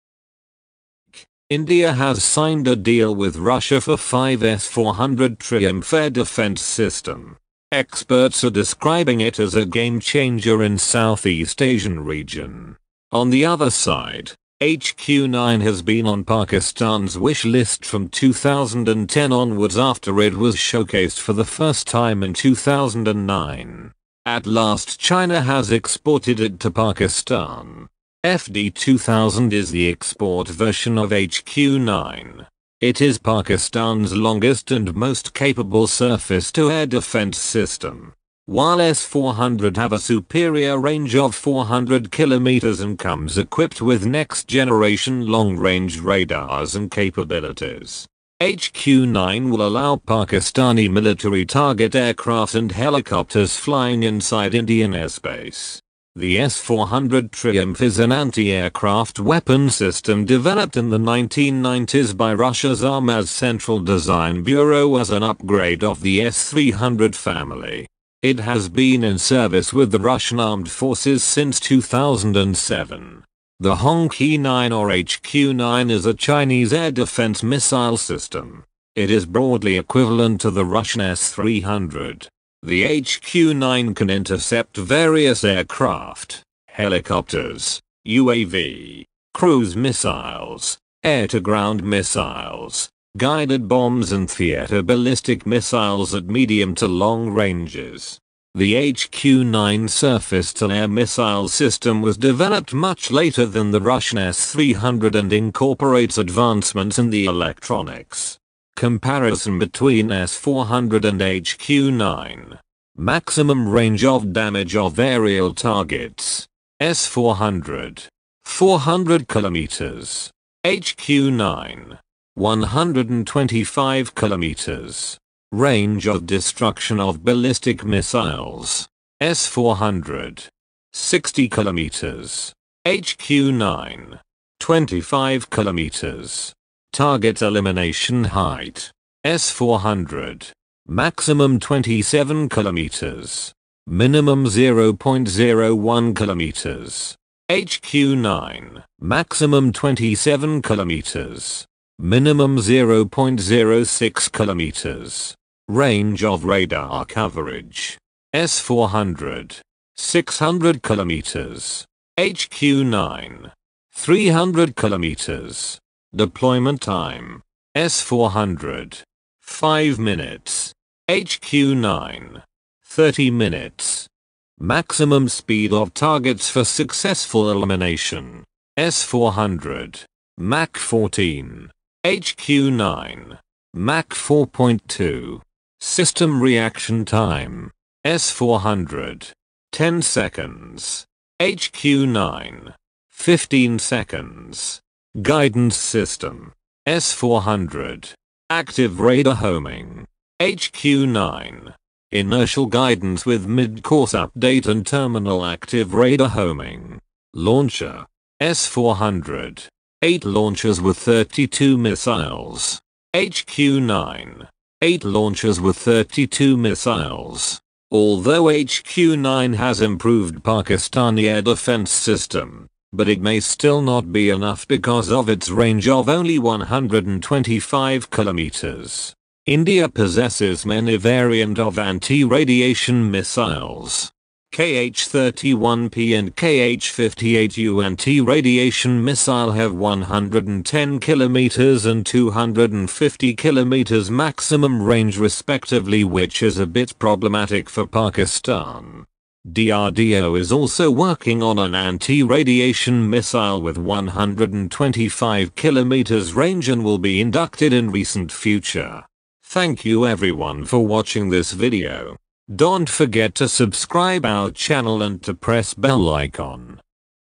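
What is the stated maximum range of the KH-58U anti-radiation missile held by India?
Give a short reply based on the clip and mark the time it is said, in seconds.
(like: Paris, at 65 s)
250 kilometers, at 242 s.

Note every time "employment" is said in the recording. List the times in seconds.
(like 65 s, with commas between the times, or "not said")
not said.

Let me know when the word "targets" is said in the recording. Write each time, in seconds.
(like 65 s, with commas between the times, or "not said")
51 s, 115 s, 136 s, 175 s.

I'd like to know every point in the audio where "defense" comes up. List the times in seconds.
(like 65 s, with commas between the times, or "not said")
6 s, 36 s, 76 s, 221 s.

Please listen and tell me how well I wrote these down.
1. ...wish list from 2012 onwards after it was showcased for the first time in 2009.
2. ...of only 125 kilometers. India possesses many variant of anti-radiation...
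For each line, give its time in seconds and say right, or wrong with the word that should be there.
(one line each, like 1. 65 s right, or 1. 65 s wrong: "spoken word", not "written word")
1. 17 s wrong: "2010", not "2012"
2. 225 s right.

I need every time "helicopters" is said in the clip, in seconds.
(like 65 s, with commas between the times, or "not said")
52 s, 86 s.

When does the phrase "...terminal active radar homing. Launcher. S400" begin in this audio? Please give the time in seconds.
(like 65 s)
204 s.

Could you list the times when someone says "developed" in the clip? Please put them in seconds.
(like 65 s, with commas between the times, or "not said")
60 s, 102 s.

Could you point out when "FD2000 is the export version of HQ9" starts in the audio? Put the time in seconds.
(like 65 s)
28 s.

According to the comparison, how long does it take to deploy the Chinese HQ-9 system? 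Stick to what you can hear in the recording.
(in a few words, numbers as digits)
30 minutes.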